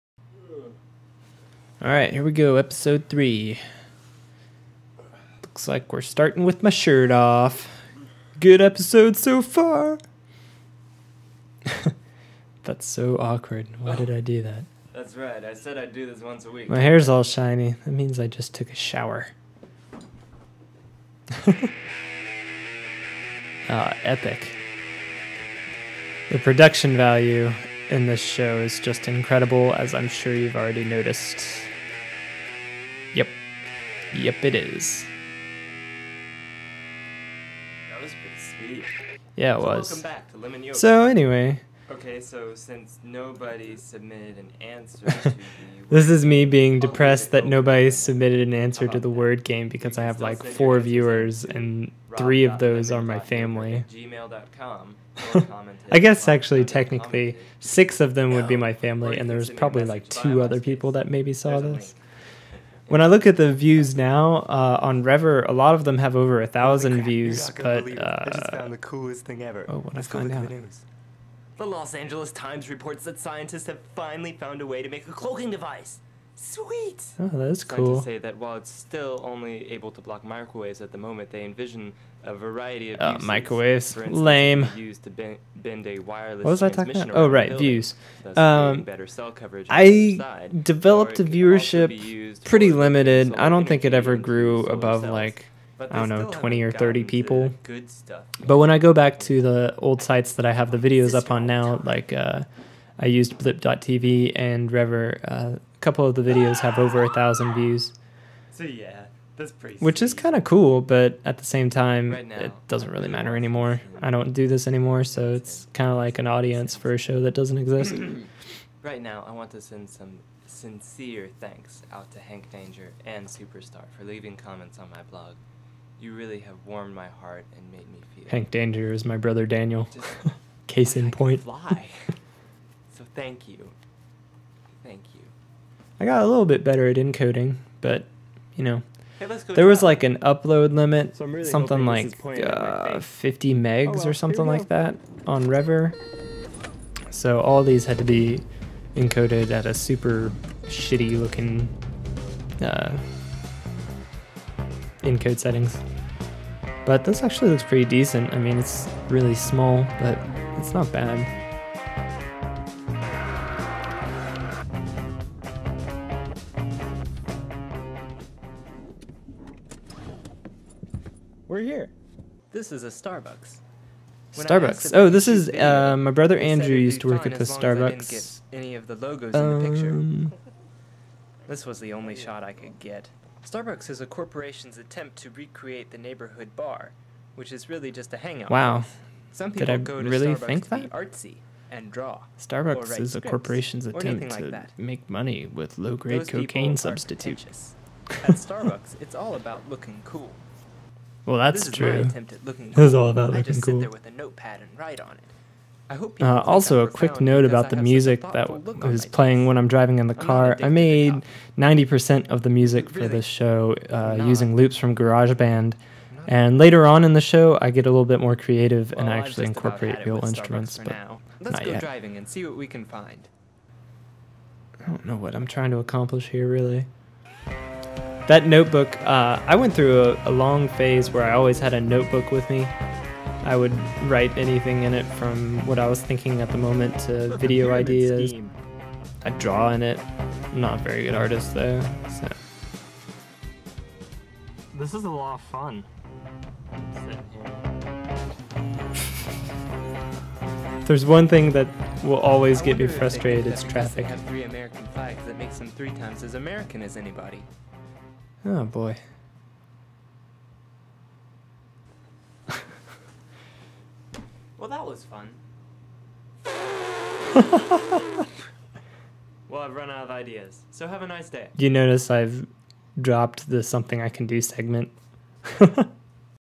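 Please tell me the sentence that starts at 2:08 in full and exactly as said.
Hank Danger is my brother Daniel.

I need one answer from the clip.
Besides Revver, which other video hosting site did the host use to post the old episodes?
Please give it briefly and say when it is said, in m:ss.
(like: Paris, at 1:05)
blip.tv, at 1:43.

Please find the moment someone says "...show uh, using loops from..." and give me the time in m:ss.
3:33.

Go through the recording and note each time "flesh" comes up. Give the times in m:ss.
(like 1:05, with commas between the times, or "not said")
not said.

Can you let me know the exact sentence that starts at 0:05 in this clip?
Looks like we're starting with my shirt off.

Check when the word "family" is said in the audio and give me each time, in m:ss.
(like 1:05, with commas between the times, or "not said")
0:53, 0:58.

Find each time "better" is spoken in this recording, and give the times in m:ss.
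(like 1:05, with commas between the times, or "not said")
1:28, 2:16.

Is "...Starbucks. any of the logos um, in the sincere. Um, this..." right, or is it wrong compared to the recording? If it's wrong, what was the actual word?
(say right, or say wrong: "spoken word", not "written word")
wrong: "picture", not "sincere".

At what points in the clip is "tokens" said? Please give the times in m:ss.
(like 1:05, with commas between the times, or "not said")
not said.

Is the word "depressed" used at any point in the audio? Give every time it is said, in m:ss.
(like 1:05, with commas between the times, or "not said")
0:46.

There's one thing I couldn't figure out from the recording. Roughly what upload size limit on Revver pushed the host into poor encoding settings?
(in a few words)
50 megs.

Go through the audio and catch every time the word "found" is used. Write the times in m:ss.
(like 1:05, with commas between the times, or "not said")
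1:08, 1:14.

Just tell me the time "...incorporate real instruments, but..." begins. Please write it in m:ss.
3:39.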